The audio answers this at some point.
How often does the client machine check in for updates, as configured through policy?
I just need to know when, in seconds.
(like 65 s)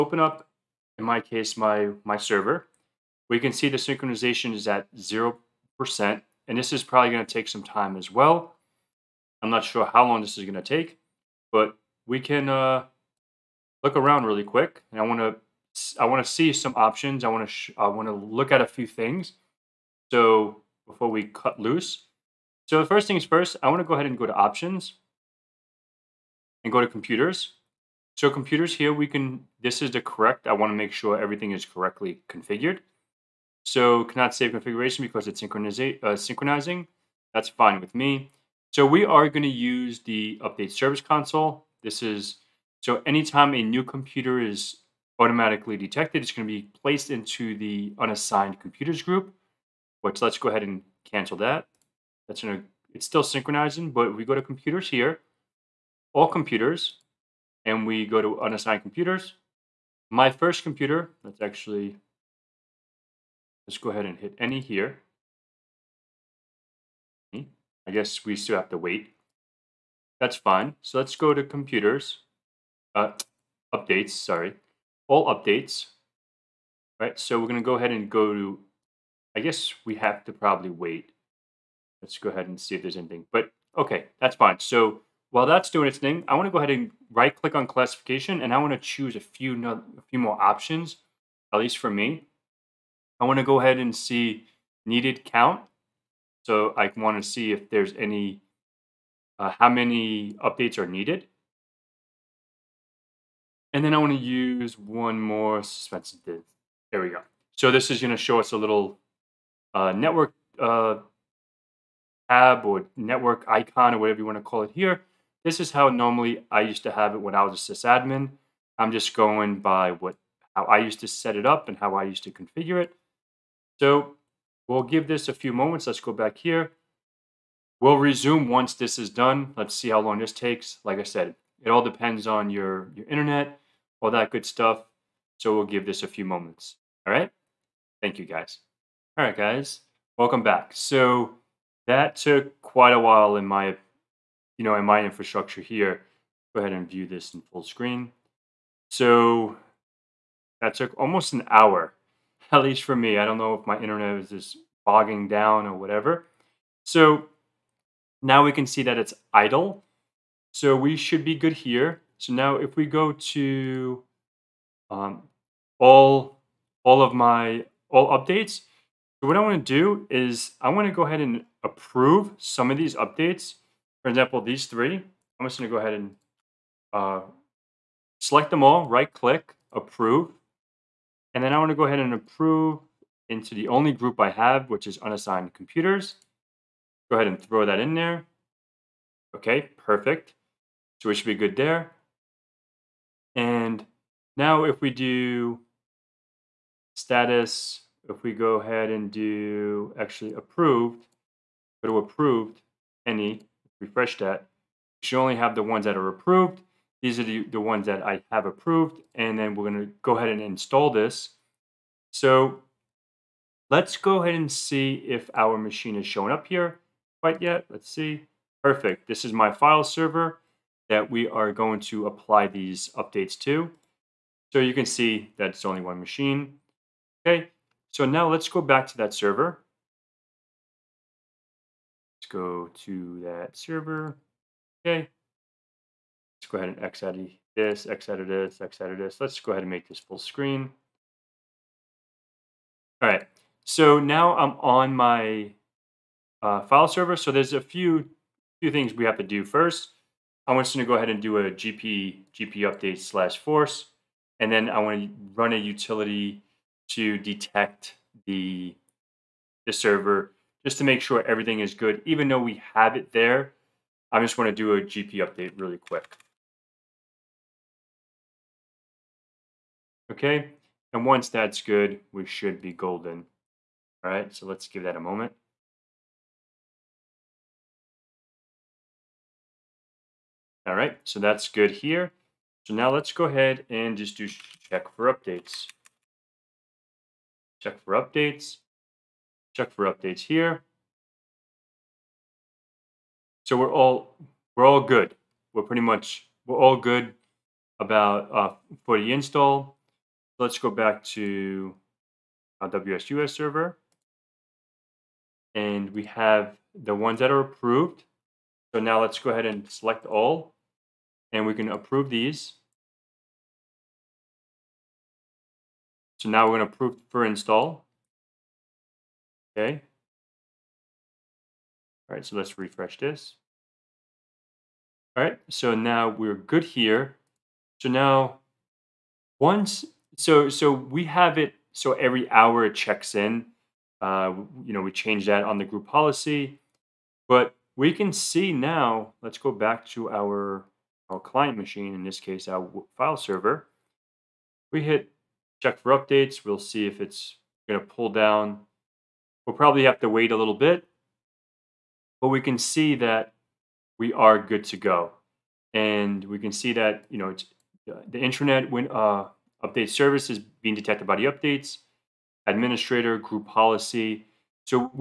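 331 s.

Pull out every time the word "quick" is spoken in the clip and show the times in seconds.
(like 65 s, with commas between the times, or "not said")
14 s, 265 s.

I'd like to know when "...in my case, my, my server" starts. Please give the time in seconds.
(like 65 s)
0 s.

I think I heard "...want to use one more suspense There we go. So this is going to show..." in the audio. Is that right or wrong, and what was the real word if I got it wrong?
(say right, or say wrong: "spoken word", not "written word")
right.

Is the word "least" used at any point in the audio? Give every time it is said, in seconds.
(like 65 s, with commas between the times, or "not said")
91 s, 152 s.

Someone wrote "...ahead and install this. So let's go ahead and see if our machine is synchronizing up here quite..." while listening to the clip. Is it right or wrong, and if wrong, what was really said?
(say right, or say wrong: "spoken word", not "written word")
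wrong: "showing", not "synchronizing".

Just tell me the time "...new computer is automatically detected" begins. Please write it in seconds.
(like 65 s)
43 s.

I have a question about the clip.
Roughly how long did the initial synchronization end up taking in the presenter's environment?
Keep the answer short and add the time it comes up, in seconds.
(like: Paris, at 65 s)
Almost an hour, at 150 s.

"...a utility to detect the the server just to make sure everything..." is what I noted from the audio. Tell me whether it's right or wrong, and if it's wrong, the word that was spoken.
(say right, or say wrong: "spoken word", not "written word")
right.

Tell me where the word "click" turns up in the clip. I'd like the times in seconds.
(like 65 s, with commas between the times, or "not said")
87 s, 179 s.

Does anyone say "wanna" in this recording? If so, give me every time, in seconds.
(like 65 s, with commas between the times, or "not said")
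15 s.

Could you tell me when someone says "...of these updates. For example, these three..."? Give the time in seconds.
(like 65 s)
172 s.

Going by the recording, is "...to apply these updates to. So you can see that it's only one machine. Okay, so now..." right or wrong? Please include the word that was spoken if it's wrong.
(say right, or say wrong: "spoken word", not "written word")
right.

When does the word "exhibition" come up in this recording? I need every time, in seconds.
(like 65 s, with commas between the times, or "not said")
not said.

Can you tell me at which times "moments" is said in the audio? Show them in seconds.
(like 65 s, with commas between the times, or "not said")
125 s, 136 s, 275 s.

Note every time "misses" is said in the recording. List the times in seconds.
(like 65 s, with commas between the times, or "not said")
not said.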